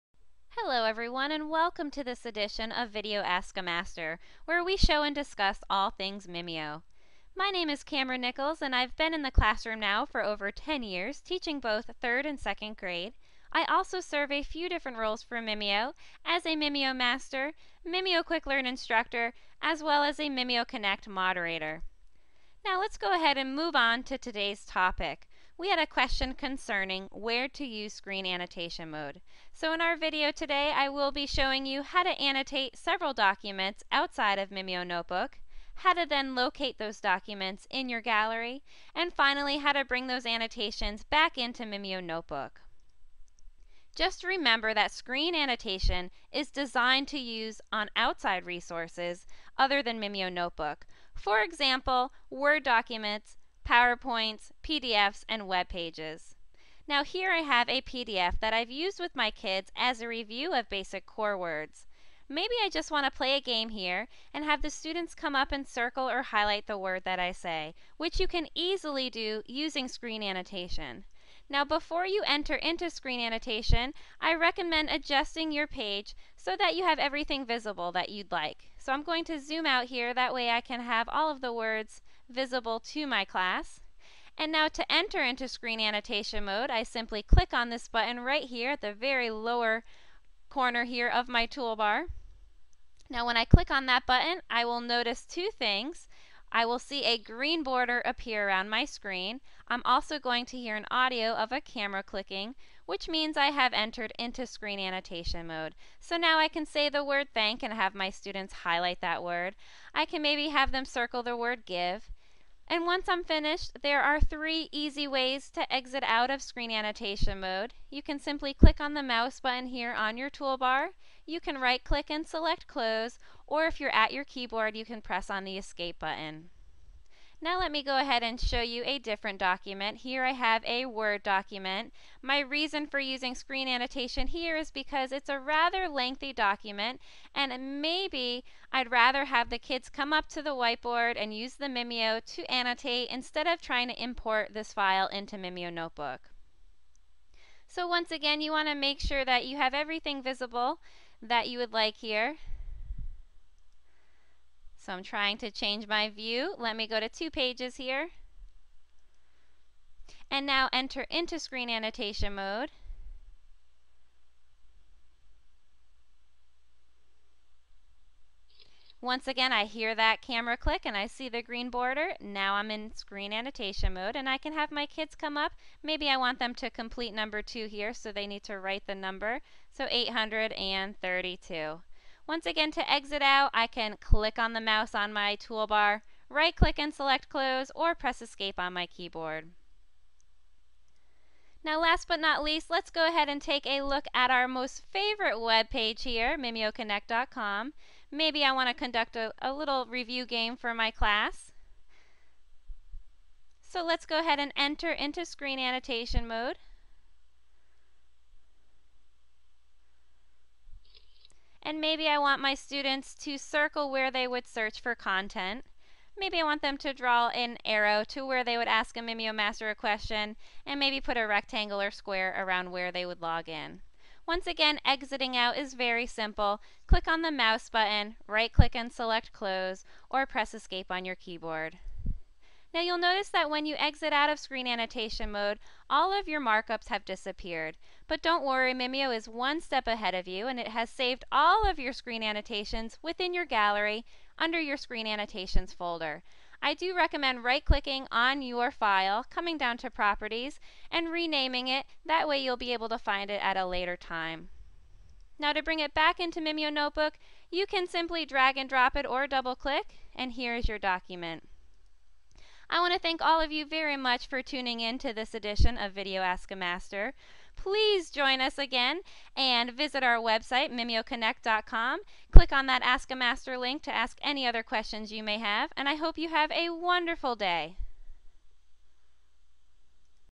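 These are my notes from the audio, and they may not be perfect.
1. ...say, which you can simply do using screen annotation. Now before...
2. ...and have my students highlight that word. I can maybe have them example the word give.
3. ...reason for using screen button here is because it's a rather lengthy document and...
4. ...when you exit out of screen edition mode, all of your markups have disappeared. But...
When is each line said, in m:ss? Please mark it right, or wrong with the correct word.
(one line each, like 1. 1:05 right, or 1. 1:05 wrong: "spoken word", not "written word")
1. 1:07 wrong: "easily", not "simply"
2. 1:47 wrong: "circle", not "example"
3. 2:12 wrong: "annotation", not "button"
4. 3:53 wrong: "annotation", not "edition".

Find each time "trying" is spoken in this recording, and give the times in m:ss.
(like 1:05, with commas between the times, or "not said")
2:23, 2:35.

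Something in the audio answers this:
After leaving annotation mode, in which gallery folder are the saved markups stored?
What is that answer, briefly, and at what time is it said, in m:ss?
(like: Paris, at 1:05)
screen annotations folder, at 4:04.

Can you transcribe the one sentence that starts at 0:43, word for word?
Just remember that screen annotation is designed to use on outside resources other than Mimio Notebook.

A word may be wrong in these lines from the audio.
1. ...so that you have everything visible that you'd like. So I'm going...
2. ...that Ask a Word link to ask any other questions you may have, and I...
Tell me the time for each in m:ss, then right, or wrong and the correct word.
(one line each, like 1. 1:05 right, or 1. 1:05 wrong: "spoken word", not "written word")
1. 1:16 right
2. 4:32 wrong: "Master", not "Word".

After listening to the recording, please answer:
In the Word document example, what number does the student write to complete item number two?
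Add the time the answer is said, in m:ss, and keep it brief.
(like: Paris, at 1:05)
832, at 2:59.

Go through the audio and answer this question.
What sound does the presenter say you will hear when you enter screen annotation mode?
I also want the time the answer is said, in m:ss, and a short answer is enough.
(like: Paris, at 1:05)
a camera clicking, at 1:41.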